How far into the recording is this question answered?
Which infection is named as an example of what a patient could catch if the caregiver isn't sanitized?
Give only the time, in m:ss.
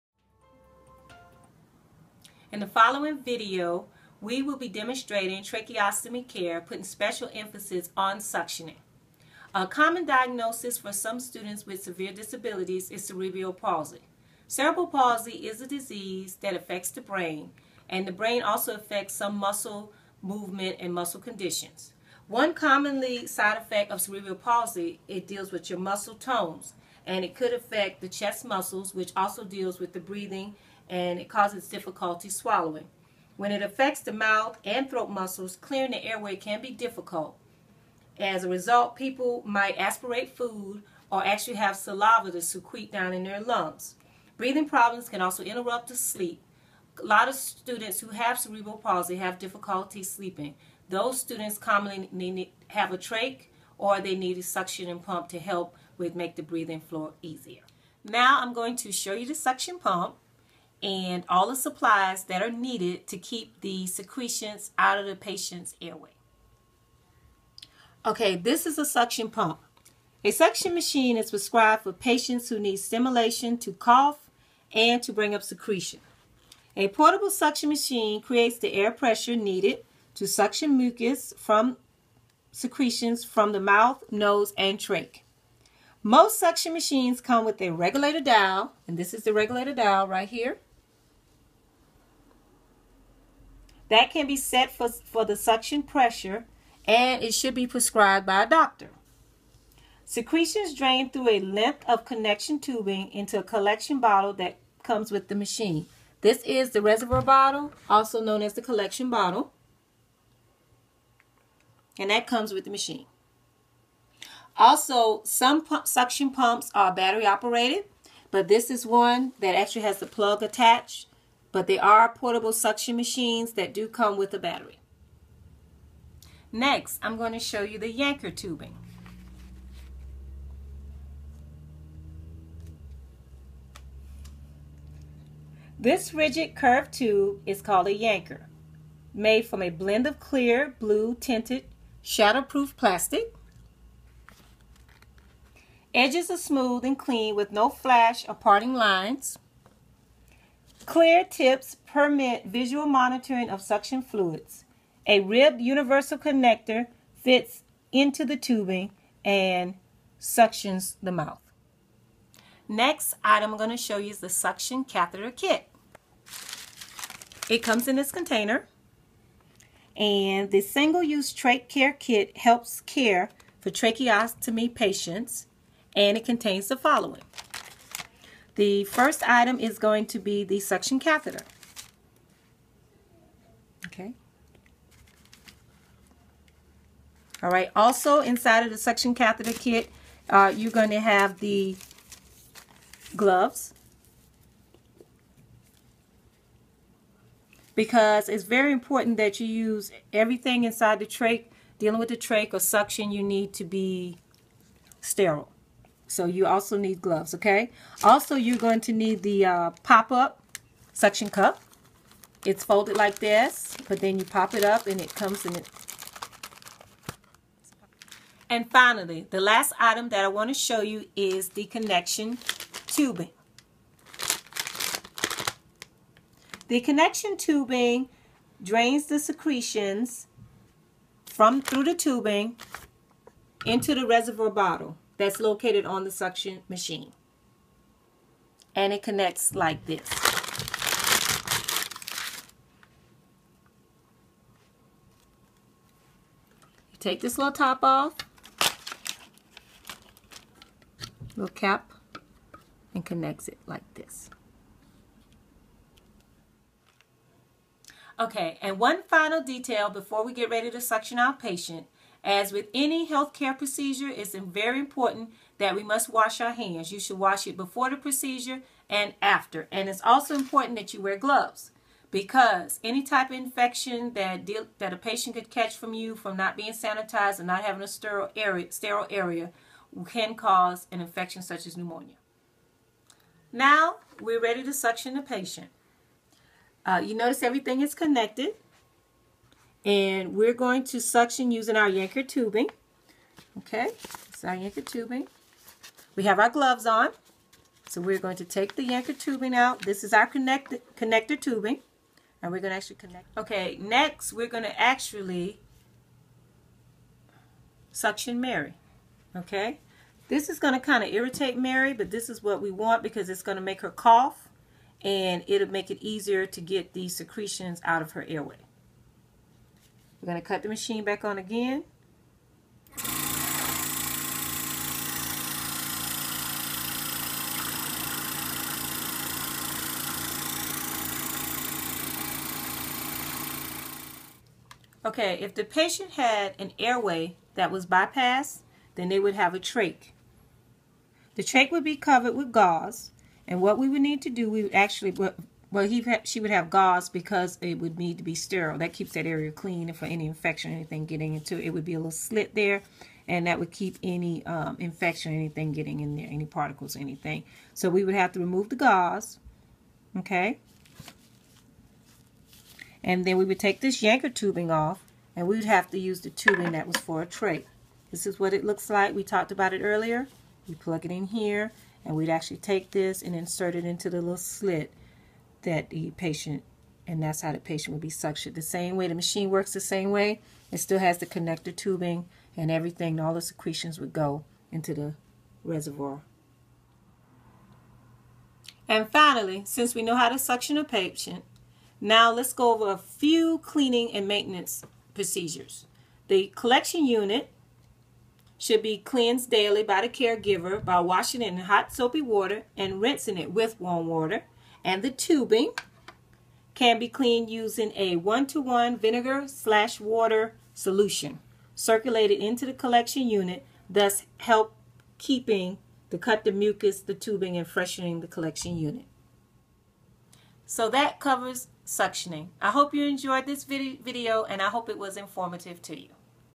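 4:41.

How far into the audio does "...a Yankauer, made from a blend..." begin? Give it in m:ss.
2:17.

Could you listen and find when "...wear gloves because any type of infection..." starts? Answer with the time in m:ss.
4:31.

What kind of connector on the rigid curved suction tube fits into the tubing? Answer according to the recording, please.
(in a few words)
ribbed universal connector.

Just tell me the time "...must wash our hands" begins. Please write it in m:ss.
4:25.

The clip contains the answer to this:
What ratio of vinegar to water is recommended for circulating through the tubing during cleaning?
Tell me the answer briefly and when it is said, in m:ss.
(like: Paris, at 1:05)
1:1, at 6:48.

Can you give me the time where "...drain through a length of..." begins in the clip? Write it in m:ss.
1:40.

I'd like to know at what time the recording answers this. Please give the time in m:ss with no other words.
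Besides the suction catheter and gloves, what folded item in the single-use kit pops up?
3:30.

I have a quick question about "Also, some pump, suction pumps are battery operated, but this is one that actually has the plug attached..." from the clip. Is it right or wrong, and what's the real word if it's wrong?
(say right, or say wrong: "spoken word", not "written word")
right.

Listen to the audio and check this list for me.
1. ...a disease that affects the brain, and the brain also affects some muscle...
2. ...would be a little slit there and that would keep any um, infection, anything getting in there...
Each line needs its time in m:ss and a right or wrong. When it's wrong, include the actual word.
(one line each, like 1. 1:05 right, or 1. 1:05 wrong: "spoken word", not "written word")
1. 0:15 right
2. 5:51 right.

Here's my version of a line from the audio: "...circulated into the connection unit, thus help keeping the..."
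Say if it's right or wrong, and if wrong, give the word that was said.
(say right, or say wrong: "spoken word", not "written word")
wrong: "collection", not "connection".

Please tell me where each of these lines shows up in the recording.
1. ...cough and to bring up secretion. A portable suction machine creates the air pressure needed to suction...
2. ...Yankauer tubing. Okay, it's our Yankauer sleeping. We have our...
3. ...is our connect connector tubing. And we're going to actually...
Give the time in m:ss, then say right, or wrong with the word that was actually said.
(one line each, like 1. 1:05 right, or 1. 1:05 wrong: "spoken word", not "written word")
1. 1:13 right
2. 4:51 wrong: "tubing", not "sleeping"
3. 5:00 right.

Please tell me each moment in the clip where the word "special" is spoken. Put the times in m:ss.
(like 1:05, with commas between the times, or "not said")
0:06.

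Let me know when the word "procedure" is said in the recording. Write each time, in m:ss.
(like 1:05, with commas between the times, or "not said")
4:23, 4:27, 6:35.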